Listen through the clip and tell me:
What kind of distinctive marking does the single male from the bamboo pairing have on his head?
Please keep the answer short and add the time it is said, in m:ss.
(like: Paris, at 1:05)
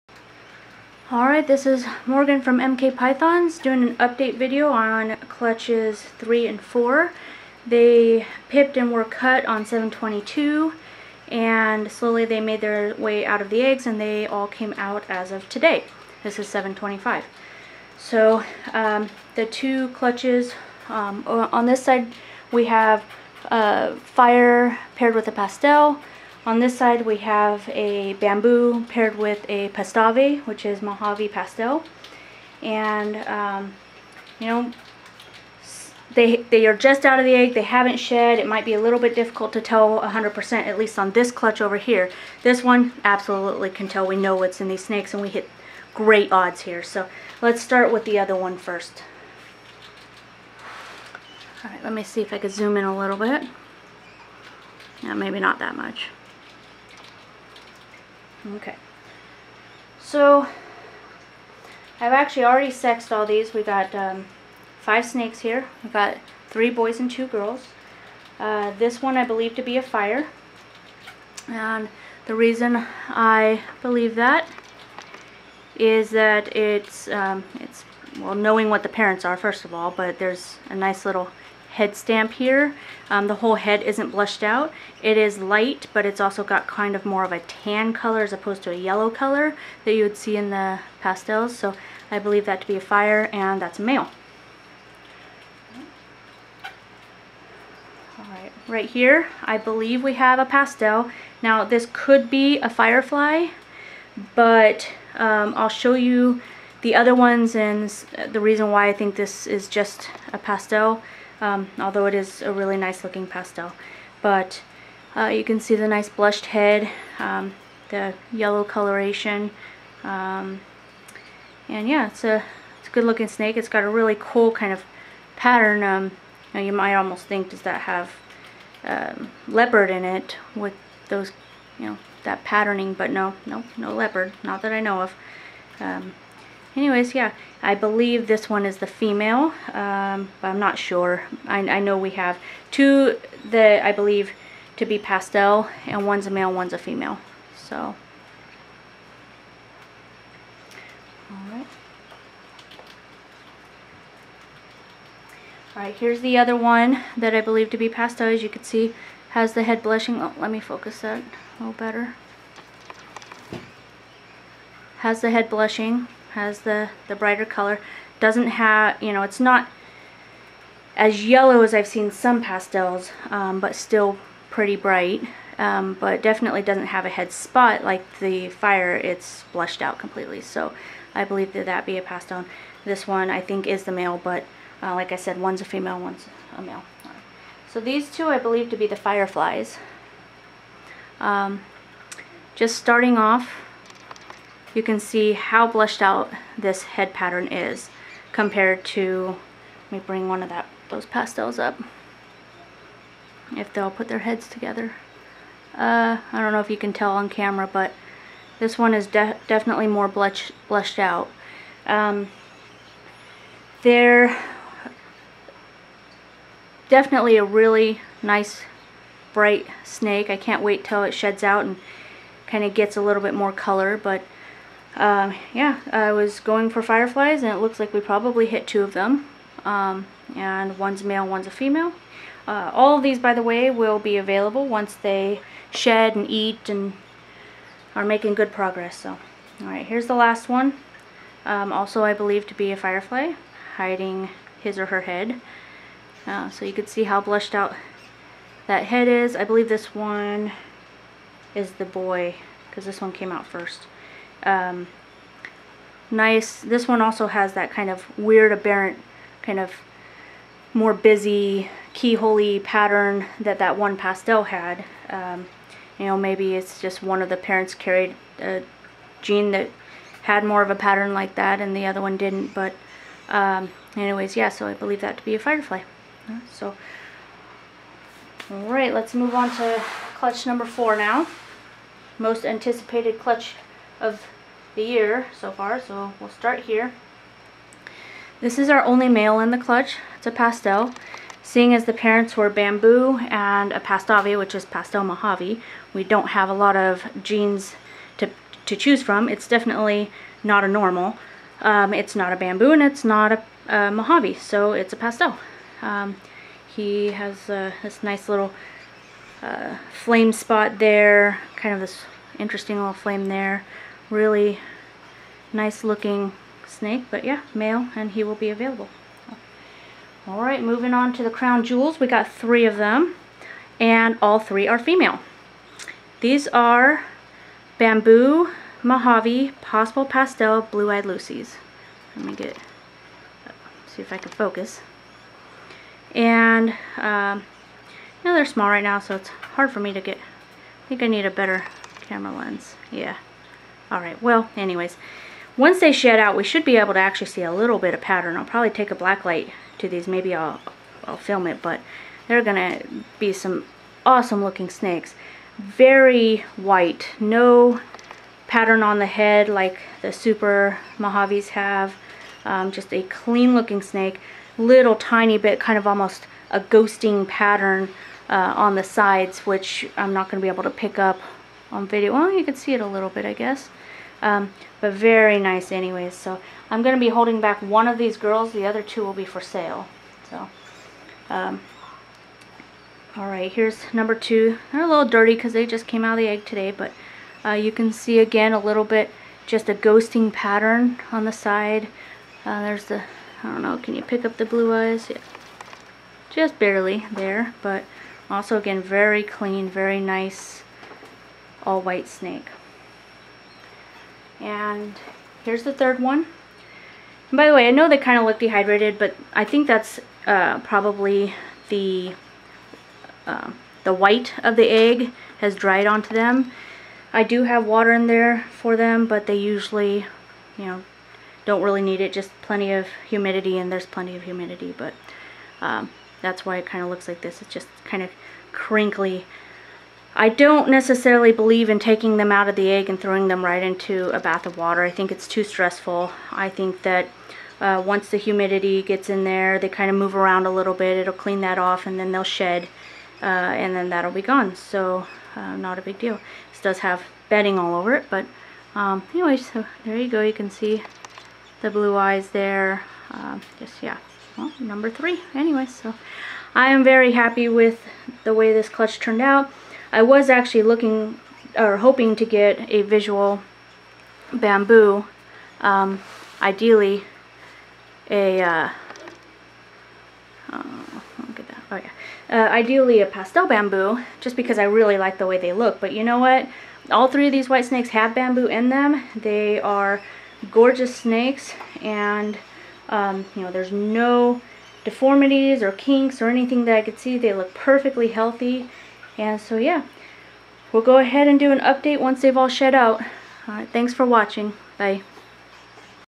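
flame spot, at 5:09.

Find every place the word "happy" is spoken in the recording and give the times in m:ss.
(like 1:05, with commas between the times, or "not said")
7:37.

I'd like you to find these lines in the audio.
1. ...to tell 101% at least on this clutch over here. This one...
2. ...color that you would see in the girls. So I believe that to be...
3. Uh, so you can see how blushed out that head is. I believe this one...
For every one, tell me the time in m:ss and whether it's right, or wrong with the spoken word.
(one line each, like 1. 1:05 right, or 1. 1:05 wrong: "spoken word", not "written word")
1. 0:39 wrong: "100", not "101"
2. 1:29 wrong: "pastels", not "girls"
3. 4:06 right.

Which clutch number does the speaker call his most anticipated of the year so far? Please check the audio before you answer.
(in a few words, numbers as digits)
4.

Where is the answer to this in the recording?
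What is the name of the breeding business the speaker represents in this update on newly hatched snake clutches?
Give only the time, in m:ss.
0:02.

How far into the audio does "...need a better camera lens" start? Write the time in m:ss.
5:41.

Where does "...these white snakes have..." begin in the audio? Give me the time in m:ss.
7:57.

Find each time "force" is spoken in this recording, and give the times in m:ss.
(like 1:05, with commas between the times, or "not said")
not said.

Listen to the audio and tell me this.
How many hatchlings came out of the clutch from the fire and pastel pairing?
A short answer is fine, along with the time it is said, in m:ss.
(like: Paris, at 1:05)
5, at 1:04.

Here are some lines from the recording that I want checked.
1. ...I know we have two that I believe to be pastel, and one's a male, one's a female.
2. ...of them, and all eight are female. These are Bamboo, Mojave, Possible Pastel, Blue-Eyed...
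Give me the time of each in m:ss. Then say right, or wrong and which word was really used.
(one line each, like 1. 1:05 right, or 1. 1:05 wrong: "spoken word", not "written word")
1. 2:21 right
2. 5:22 wrong: "three", not "eight".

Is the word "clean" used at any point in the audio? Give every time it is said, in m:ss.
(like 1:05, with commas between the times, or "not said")
6:03, 6:39, 7:21.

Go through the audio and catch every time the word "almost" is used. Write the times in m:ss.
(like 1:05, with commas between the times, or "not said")
2:06, 6:05.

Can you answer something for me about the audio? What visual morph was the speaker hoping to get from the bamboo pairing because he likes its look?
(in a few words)
pastel bamboo.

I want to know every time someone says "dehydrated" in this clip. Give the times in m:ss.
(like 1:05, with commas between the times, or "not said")
6:48.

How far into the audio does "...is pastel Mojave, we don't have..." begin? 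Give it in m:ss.
4:54.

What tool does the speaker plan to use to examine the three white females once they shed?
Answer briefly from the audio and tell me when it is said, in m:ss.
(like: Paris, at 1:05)
black light, at 5:48.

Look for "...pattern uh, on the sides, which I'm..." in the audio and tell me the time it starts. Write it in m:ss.
6:07.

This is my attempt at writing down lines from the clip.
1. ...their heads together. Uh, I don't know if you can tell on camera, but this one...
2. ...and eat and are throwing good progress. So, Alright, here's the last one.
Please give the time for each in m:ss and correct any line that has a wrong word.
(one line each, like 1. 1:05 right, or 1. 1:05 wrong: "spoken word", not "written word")
1. 3:24 right
2. 3:56 wrong: "making", not "throwing".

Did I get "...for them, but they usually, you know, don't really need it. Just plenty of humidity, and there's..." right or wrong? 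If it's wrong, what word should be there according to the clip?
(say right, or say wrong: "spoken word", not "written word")
right.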